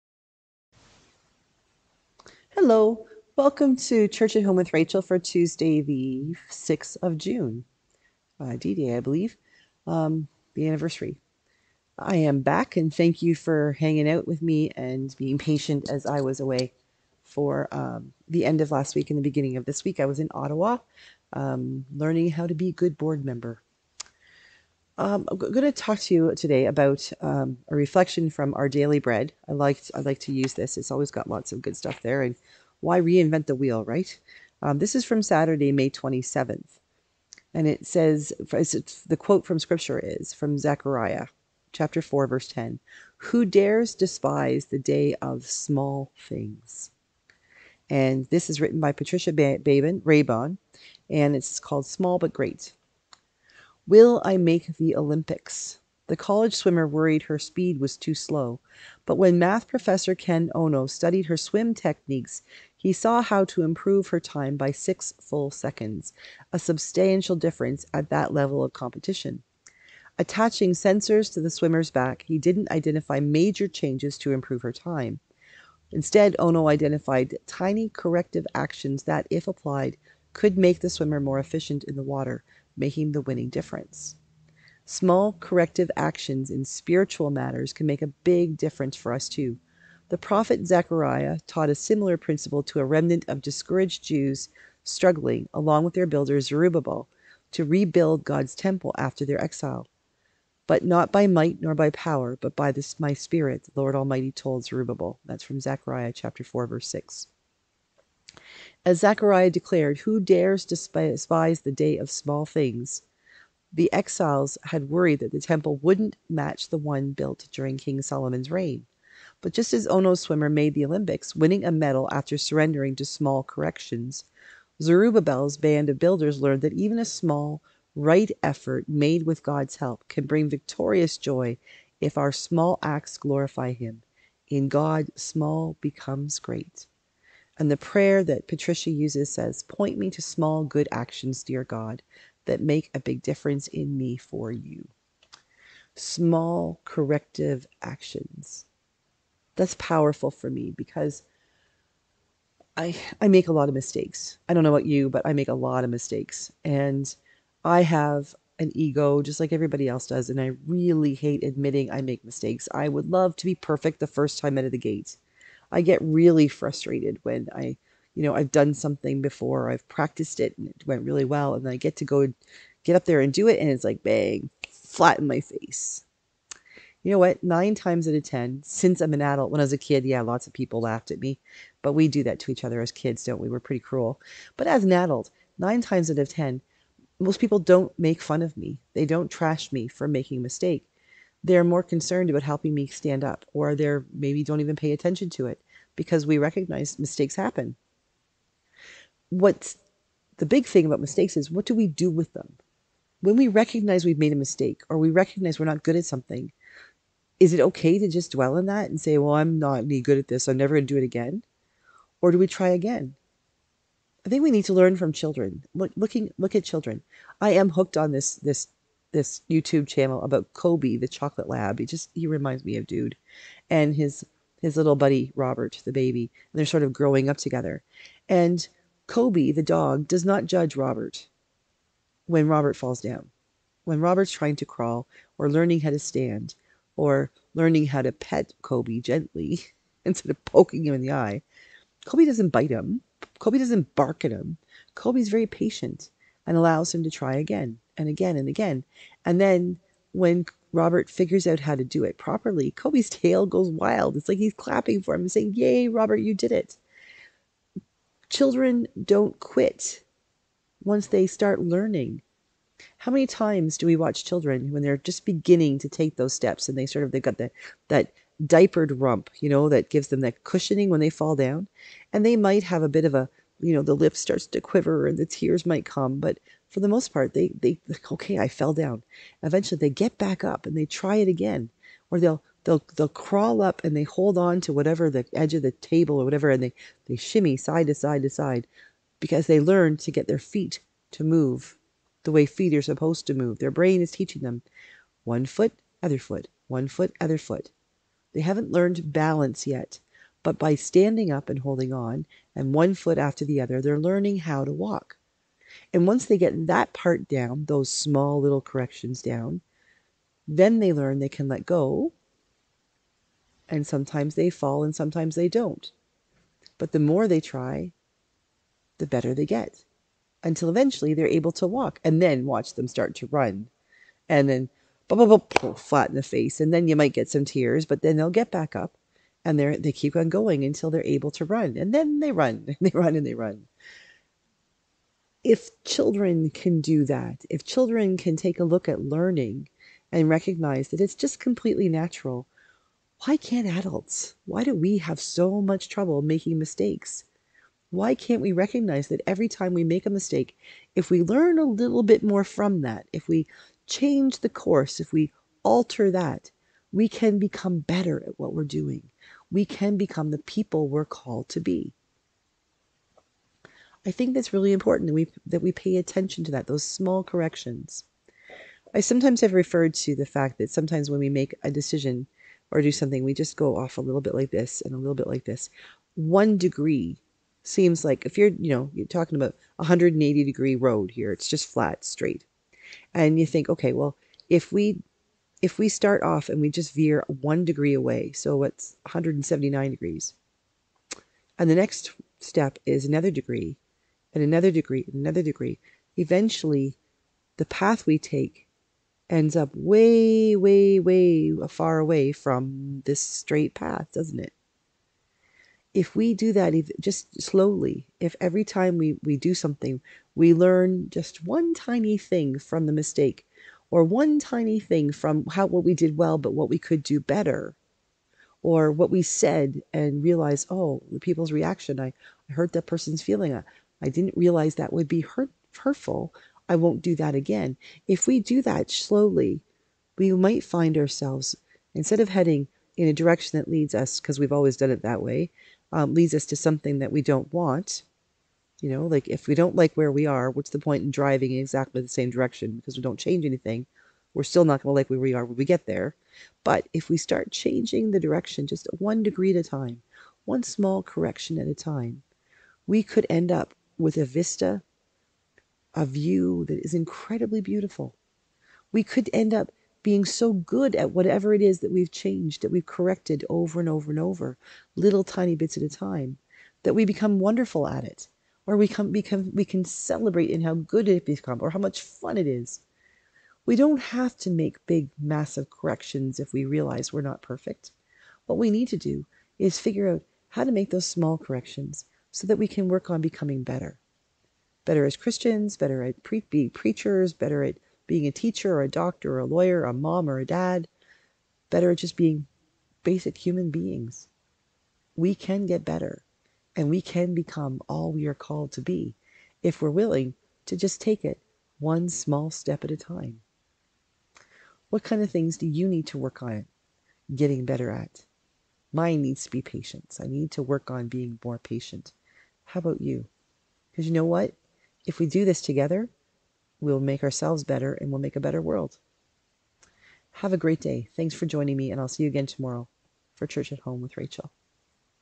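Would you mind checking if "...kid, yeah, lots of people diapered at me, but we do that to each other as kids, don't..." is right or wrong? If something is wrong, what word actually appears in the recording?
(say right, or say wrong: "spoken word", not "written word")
wrong: "laughed", not "diapered".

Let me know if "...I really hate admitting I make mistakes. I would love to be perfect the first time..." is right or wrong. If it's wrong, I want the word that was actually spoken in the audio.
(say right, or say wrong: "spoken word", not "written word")
right.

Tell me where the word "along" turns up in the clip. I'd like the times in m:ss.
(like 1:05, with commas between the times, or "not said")
1:35.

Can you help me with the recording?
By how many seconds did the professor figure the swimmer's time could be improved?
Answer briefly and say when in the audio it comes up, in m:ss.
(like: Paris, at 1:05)
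6, at 1:04.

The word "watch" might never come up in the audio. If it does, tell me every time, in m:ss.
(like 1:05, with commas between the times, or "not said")
4:23, 5:22.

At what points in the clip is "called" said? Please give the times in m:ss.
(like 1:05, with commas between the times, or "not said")
0:51, 6:01, 8:18.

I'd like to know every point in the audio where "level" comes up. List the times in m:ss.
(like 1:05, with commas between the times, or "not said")
1:08.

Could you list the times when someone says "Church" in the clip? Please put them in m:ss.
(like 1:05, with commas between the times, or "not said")
0:04, 8:43.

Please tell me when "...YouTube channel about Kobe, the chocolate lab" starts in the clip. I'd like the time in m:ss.
3:39.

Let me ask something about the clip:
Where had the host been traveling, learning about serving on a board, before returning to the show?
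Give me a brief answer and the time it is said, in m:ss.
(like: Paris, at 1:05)
Ottawa, at 0:20.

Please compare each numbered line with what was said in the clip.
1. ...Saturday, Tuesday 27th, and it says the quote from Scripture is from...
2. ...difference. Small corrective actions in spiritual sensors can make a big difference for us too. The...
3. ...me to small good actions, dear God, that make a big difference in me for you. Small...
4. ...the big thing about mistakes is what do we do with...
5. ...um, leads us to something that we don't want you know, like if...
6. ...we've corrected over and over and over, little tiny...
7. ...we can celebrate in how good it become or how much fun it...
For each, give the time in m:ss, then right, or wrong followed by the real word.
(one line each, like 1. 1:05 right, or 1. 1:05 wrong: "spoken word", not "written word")
1. 0:35 wrong: "May", not "Tuesday"
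2. 1:23 wrong: "matters", not "sensors"
3. 2:19 right
4. 3:20 right
5. 7:15 right
6. 7:42 right
7. 7:49 right.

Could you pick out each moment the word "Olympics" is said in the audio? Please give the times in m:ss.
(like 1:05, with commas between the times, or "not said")
0:54, 2:00.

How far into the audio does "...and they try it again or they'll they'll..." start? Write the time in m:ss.
4:40.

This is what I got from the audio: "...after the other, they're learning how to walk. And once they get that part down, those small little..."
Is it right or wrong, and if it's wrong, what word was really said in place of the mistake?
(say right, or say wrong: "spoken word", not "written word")
right.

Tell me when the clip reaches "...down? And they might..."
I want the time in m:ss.
4:31.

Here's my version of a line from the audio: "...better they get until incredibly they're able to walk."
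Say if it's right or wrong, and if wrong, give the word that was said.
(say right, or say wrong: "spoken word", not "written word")
wrong: "eventually", not "incredibly".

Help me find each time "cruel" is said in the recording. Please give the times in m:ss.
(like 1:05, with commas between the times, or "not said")
3:03.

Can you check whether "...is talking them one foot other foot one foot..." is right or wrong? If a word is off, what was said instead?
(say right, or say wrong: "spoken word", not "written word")
wrong: "teaching", not "talking".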